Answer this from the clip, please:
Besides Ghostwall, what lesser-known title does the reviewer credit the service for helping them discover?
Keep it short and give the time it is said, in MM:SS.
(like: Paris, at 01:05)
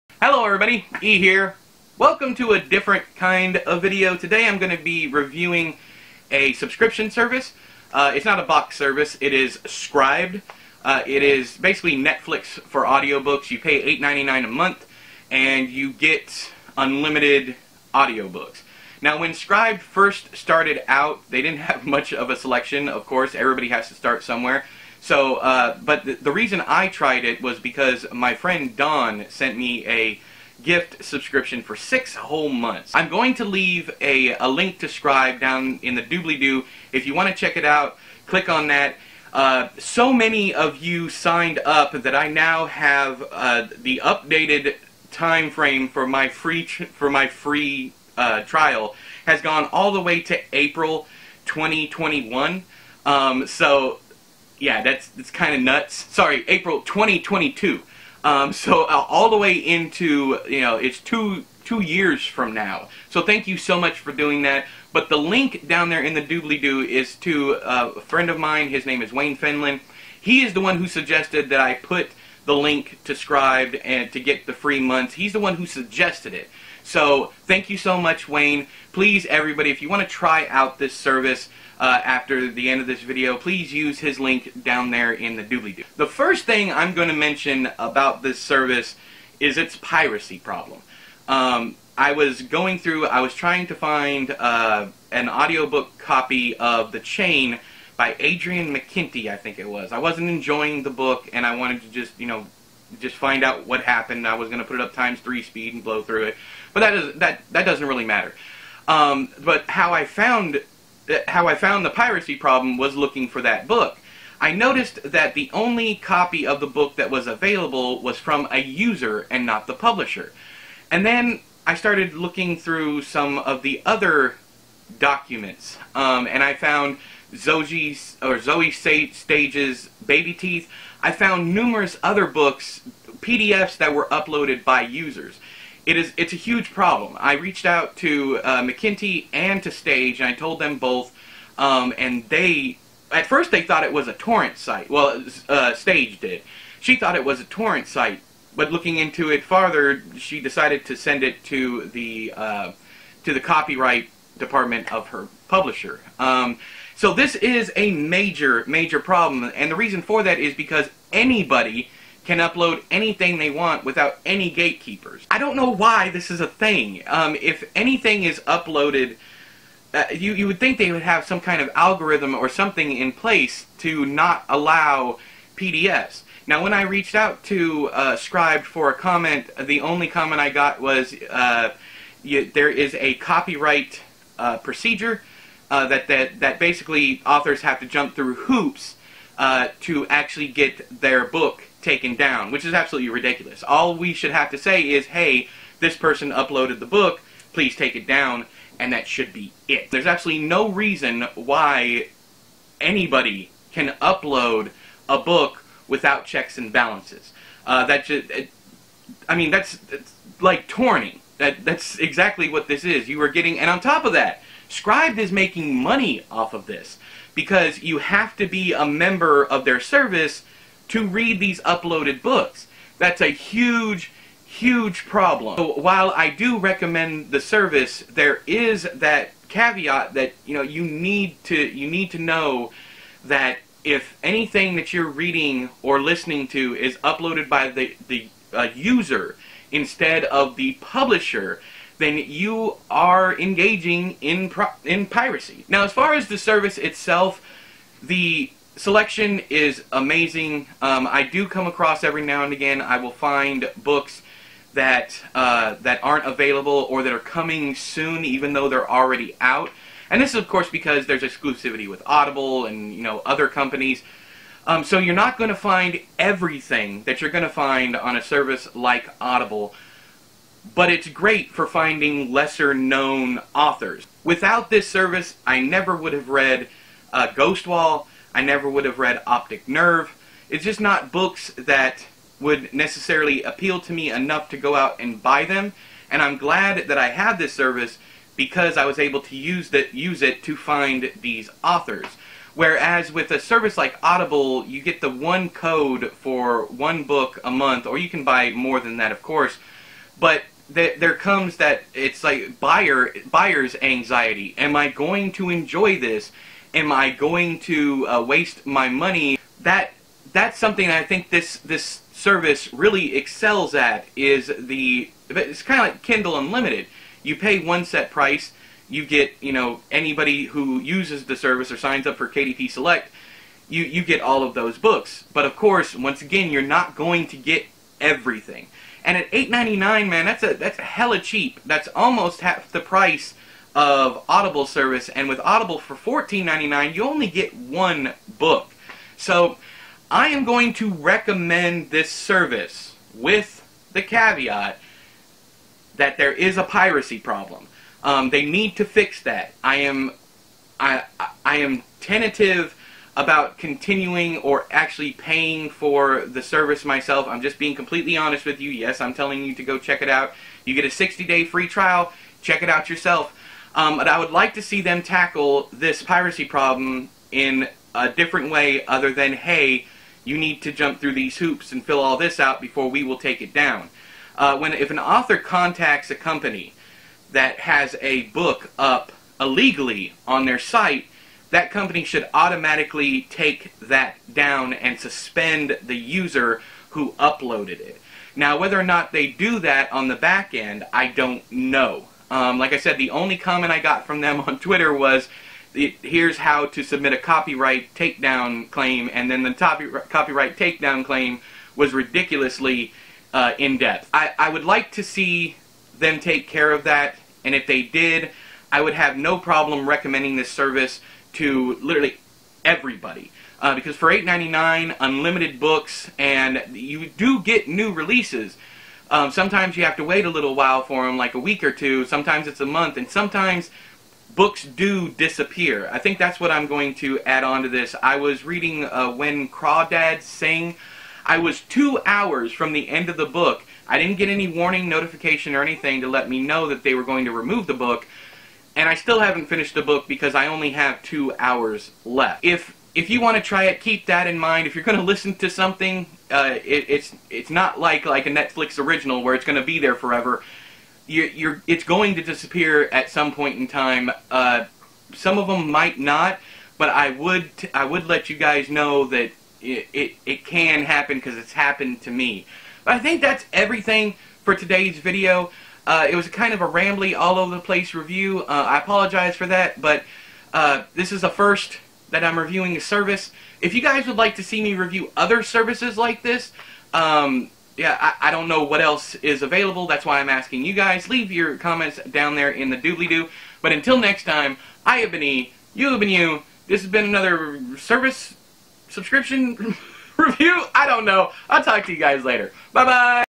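Optic Nerve, at 04:39.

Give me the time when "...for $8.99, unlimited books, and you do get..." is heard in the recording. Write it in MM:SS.
06:53.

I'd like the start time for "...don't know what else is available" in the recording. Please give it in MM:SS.
07:58.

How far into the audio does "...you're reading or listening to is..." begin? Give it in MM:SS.
03:54.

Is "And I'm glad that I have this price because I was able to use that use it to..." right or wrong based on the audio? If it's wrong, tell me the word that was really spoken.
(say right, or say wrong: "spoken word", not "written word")
wrong: "service", not "price".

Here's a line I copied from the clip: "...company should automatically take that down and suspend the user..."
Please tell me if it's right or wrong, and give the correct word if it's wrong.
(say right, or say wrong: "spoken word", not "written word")
right.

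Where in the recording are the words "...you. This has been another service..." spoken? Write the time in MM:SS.
08:06.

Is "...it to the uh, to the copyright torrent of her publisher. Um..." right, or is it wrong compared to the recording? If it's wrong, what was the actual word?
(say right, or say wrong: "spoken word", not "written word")
wrong: "department", not "torrent".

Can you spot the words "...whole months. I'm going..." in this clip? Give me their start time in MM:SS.
00:32.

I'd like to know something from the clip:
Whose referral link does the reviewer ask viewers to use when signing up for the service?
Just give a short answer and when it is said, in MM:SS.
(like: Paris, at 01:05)
Wayne Finland, at 01:09.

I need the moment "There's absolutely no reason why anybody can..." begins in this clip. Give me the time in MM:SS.
03:19.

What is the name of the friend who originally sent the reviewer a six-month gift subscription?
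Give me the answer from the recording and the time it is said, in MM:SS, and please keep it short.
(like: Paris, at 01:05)
Don, at 00:28.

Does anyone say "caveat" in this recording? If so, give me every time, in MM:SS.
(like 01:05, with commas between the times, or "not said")
03:49, 05:44.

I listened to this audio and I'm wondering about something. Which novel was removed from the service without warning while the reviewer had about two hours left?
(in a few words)
When Crawdads Sing.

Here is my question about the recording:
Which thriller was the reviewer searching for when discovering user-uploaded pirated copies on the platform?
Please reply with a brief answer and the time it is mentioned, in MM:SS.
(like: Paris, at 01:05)
The Chain, at 01:36.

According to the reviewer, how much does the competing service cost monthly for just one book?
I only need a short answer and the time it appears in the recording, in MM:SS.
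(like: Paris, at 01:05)
$14.99, at 05:35.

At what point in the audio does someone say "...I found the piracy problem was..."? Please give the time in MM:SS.
01:51.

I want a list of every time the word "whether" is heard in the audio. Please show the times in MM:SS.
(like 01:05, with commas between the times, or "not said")
06:28.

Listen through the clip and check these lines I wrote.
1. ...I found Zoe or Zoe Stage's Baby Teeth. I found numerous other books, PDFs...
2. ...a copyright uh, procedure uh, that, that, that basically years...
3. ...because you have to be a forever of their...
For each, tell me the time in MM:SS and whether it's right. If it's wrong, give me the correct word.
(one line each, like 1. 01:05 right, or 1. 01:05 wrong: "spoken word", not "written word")
1. 02:06 right
2. 03:02 wrong: "authors", not "years"
3. 03:37 wrong: "member", not "forever".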